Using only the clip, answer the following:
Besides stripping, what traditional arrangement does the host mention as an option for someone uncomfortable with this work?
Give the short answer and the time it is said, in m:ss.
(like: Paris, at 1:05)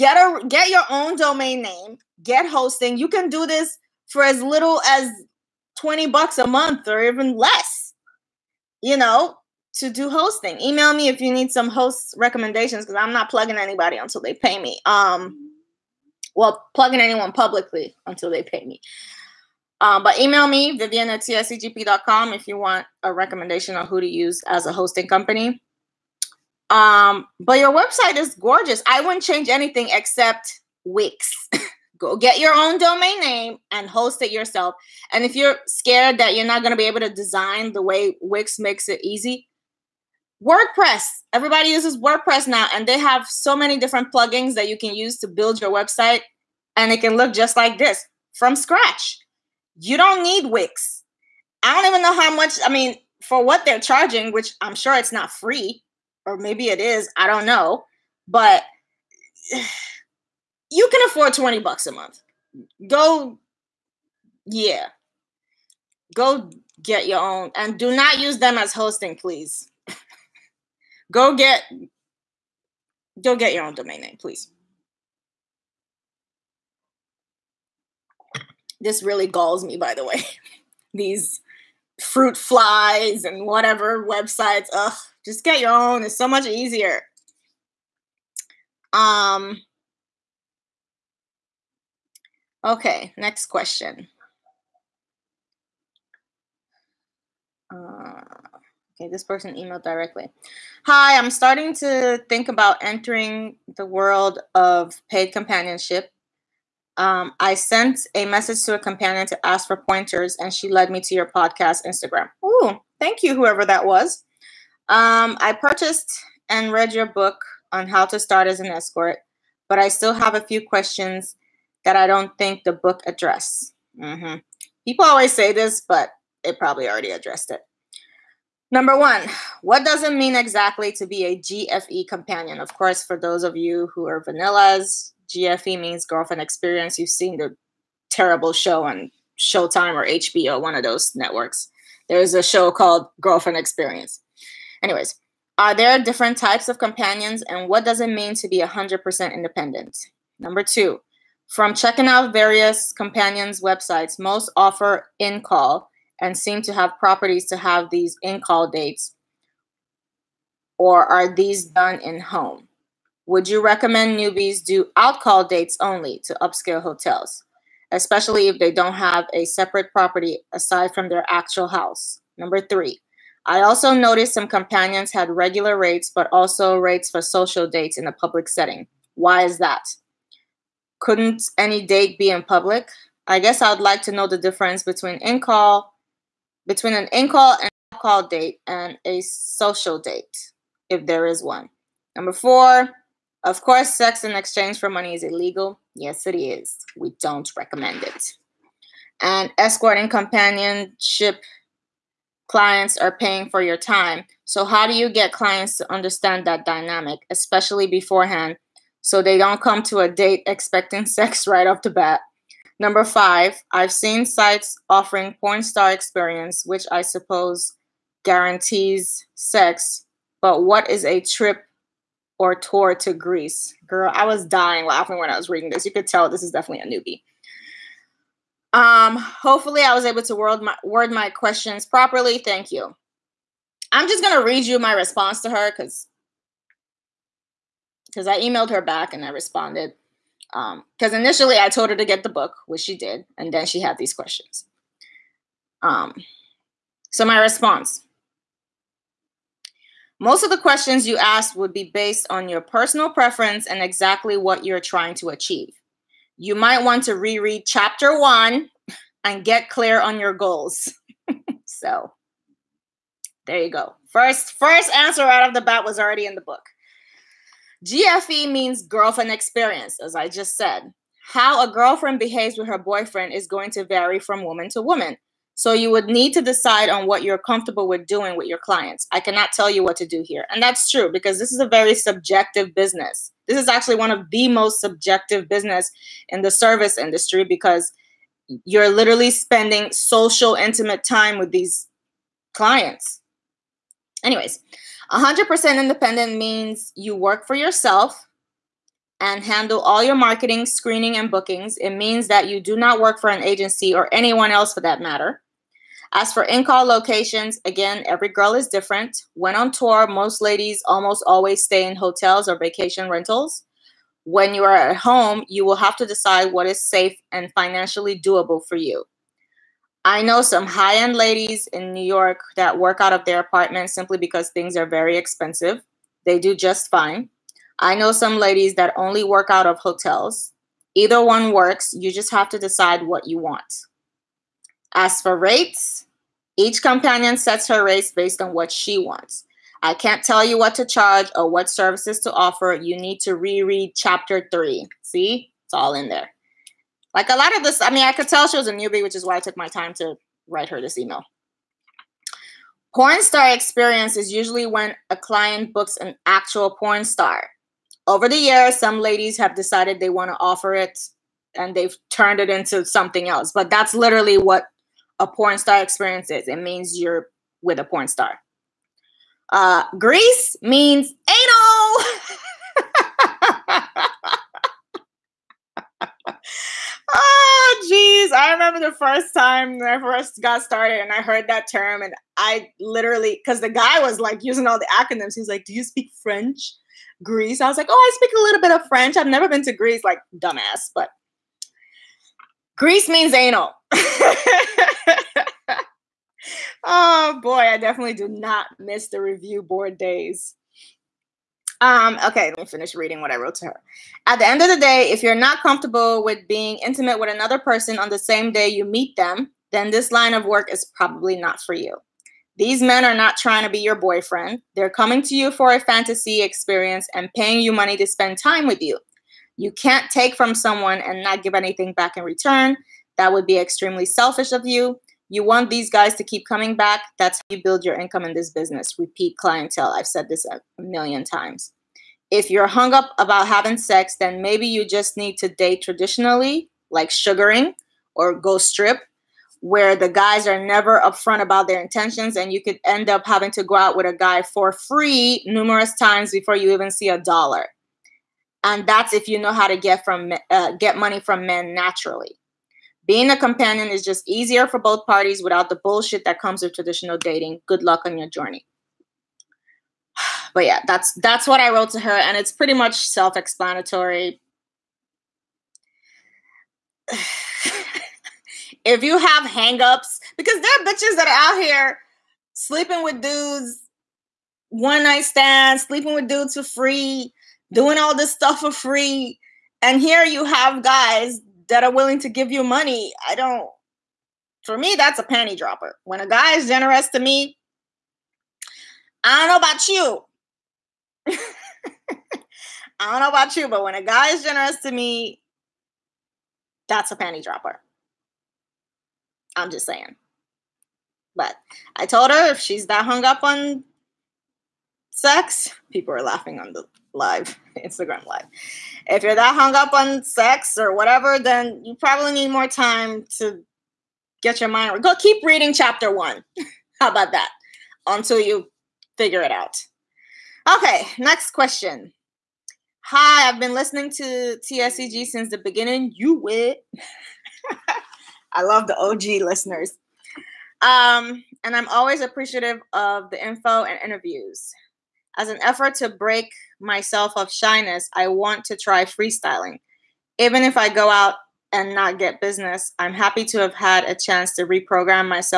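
Sugaring, at 7:17.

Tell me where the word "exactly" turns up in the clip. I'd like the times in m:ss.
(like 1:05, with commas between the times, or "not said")
2:10, 4:13.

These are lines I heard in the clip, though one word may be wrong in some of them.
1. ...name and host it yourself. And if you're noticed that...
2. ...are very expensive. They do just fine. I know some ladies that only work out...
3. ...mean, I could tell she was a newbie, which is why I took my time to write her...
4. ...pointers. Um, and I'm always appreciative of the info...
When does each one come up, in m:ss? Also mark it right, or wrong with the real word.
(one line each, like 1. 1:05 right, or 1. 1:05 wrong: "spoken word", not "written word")
1. 0:33 wrong: "scared", not "noticed"
2. 5:24 right
3. 5:47 right
4. 8:49 wrong: "listeners", not "pointers".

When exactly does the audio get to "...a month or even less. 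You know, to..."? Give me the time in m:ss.
0:06.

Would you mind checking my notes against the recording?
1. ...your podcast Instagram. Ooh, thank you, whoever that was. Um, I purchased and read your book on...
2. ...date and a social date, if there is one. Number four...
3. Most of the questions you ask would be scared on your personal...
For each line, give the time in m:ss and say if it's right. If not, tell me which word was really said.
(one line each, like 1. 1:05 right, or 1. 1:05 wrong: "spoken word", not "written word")
1. 1:51 right
2. 3:08 right
3. 4:10 wrong: "based", not "scared".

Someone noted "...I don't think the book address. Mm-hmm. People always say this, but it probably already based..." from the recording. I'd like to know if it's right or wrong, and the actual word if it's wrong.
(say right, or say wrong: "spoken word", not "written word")
wrong: "addressed", not "based".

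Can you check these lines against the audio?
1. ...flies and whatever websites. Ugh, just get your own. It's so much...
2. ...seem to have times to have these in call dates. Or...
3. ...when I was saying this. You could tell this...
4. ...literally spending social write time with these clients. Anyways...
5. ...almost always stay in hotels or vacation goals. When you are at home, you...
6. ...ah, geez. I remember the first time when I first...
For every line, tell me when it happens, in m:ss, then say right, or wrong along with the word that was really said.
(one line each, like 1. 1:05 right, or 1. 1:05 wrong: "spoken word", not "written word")
1. 1:22 right
2. 2:36 wrong: "properties", not "times"
3. 3:45 wrong: "reading", not "saying"
4. 4:48 wrong: "intimate", not "write"
5. 5:10 wrong: "rentals", not "goals"
6. 6:15 right.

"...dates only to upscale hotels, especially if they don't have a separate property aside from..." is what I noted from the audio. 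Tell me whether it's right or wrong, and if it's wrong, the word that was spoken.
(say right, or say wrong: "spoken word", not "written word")
right.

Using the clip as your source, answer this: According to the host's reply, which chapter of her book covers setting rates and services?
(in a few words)
Chapter three.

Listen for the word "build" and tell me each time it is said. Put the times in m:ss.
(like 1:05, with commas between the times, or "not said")
0:45, 7:07.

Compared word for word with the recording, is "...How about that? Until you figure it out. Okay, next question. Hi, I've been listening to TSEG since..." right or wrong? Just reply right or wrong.
right.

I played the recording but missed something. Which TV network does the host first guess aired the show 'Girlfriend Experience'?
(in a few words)
Showtime.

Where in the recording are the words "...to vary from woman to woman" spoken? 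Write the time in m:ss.
4:33.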